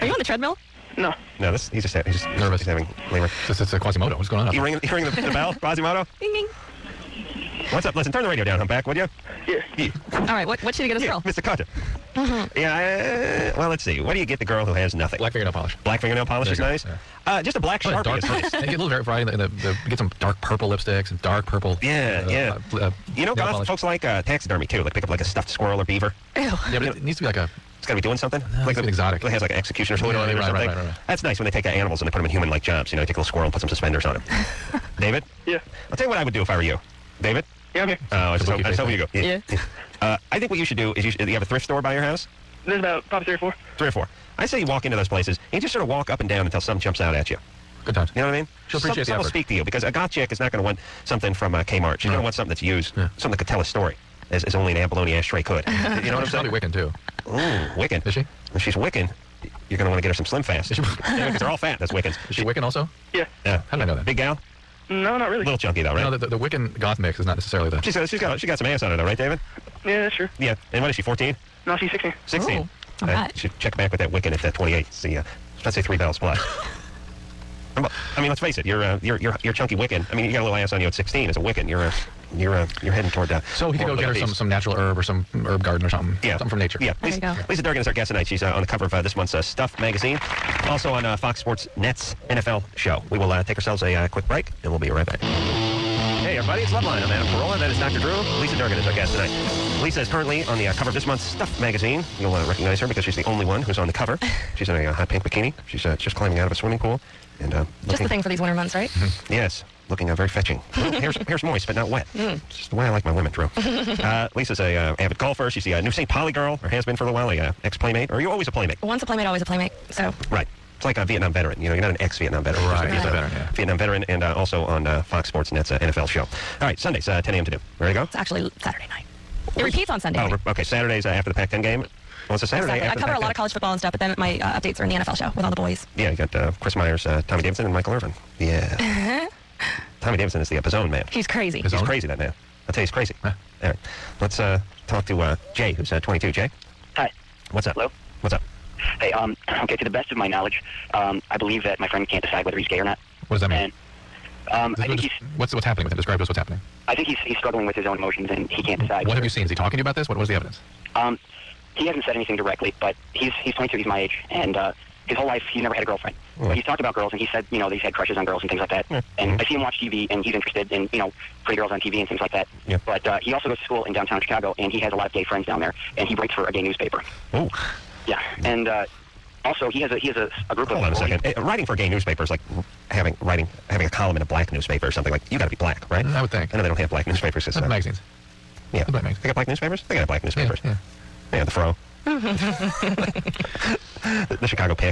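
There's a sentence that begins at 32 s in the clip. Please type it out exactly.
You know, they take a little squirrel and put some suspenders on him.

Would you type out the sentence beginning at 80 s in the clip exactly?
I mean, you got a little ass on you at 16 as a Wiccan.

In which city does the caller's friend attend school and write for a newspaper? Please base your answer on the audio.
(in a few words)
Chicago.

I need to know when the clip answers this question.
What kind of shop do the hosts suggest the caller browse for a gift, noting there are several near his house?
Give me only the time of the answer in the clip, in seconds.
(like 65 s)
41 s.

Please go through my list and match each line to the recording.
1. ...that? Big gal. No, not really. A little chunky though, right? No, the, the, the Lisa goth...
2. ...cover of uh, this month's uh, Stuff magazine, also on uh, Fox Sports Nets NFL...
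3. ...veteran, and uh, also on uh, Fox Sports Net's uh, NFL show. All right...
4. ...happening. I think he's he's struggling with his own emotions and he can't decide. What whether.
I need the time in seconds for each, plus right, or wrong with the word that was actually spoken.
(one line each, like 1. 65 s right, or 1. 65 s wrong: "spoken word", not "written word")
1. 63 s wrong: "Wiccan", not "Lisa"
2. 88 s right
3. 123 s right
4. 156 s right.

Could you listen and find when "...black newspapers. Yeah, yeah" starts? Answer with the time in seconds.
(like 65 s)
190 s.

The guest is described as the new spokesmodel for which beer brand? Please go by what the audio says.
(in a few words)
St. Pauli.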